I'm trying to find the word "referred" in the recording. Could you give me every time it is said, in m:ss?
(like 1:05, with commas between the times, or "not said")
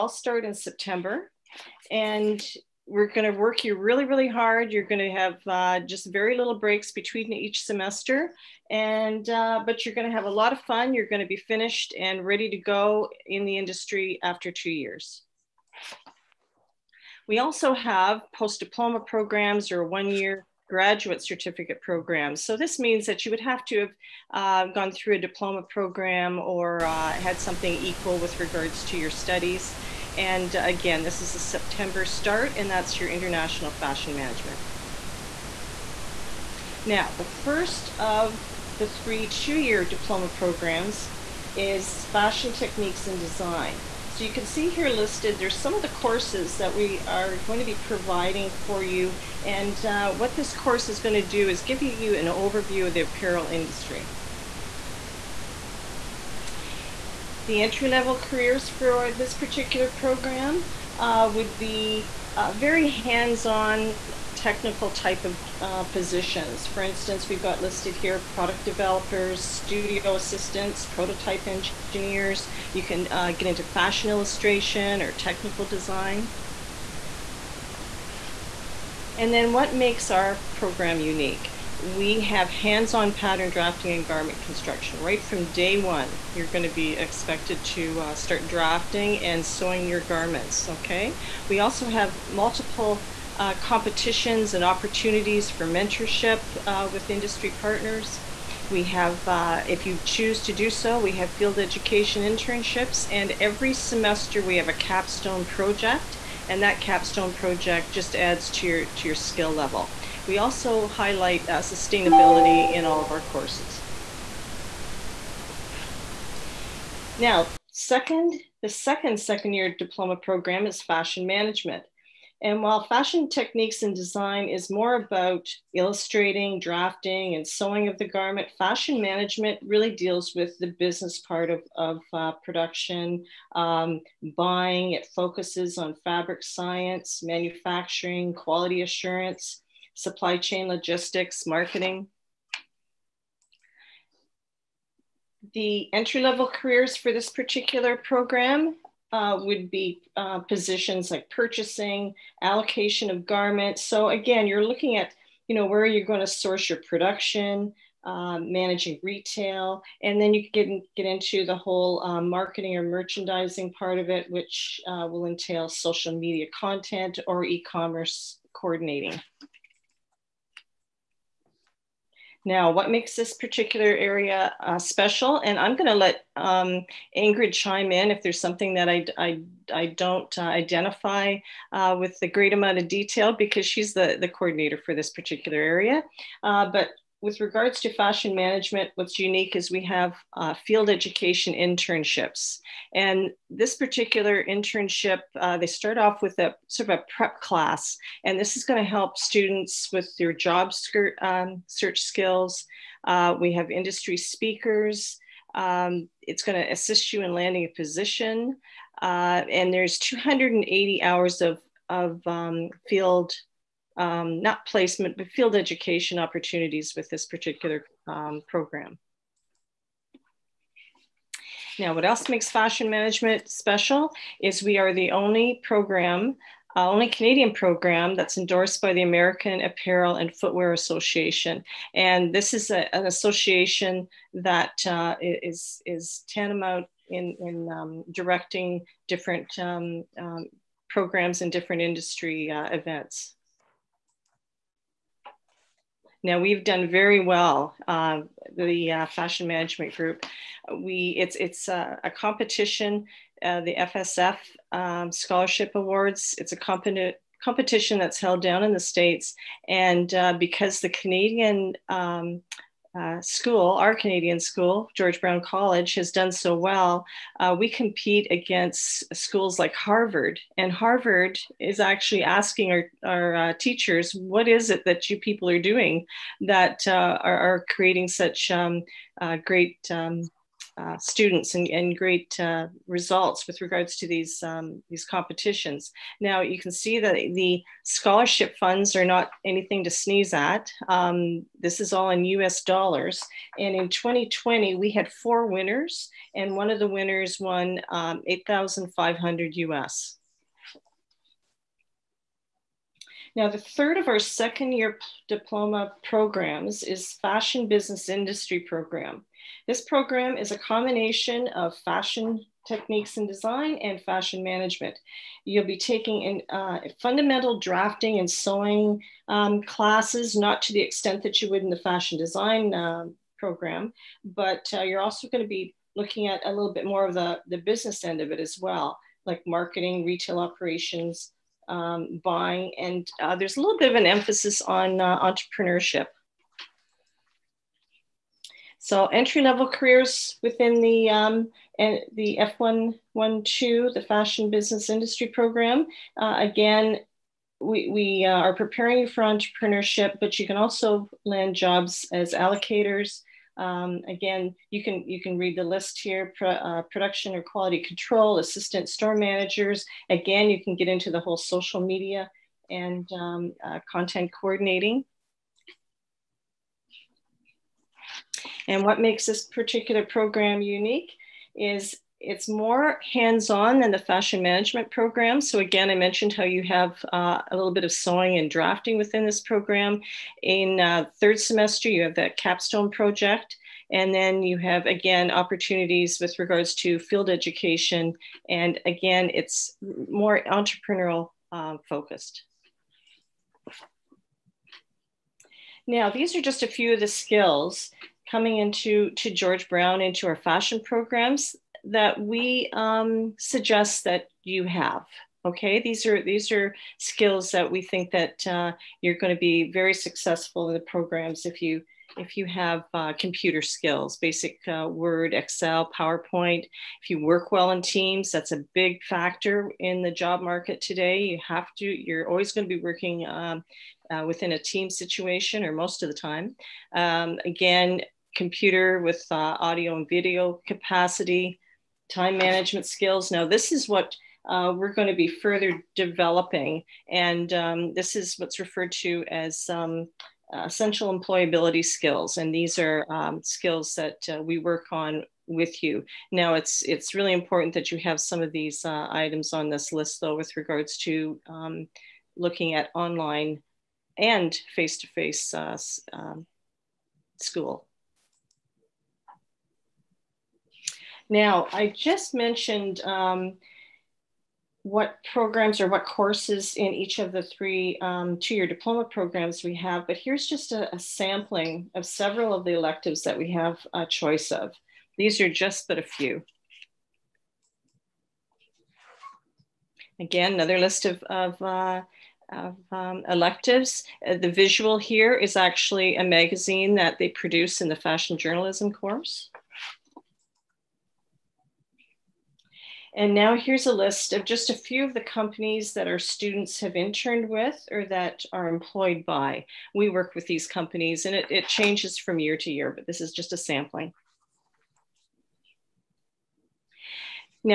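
7:18.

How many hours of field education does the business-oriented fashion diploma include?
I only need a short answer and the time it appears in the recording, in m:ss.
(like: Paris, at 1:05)
280, at 3:29.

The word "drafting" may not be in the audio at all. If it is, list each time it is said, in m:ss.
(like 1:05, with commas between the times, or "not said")
1:23, 1:28, 2:06, 5:17, 6:18.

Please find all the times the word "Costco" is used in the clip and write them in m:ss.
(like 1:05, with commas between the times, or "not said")
not said.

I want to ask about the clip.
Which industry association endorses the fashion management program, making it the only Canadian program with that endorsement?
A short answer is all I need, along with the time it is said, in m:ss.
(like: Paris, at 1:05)
American Apparel and Footwear Association, at 3:49.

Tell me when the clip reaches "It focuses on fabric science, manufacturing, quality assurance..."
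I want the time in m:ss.
2:14.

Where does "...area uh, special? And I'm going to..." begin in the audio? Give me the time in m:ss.
2:53.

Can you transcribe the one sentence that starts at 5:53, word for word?
Um, again, you can you can read the list here: pro, uh, production or quality control, assistant store managers.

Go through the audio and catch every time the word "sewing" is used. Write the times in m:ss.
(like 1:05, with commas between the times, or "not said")
1:29, 2:07, 5:18, 6:17.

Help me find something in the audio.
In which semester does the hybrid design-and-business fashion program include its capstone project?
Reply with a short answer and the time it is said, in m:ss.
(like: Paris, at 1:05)
Third semester, at 6:21.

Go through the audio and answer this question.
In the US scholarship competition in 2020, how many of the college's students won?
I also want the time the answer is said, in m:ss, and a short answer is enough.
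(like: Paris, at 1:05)
4, at 4:55.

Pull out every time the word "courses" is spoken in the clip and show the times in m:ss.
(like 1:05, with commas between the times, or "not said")
0:45, 0:50, 1:53, 7:46, 8:08.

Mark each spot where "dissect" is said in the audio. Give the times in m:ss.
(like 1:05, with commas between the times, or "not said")
not said.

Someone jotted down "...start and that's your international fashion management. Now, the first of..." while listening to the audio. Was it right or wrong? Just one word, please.
right.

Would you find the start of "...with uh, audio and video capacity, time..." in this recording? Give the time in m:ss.
7:08.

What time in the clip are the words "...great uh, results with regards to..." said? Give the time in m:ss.
4:41.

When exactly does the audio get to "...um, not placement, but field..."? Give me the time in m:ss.
3:33.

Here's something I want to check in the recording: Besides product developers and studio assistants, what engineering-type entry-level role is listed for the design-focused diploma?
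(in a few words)
Prototype engineers.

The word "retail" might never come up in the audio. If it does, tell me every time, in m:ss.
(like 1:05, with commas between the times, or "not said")
2:39, 5:30.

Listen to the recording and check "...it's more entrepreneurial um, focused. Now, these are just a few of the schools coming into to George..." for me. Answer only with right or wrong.
wrong.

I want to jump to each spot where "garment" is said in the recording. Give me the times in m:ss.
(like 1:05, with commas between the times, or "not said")
1:24, 1:30, 2:08, 2:33.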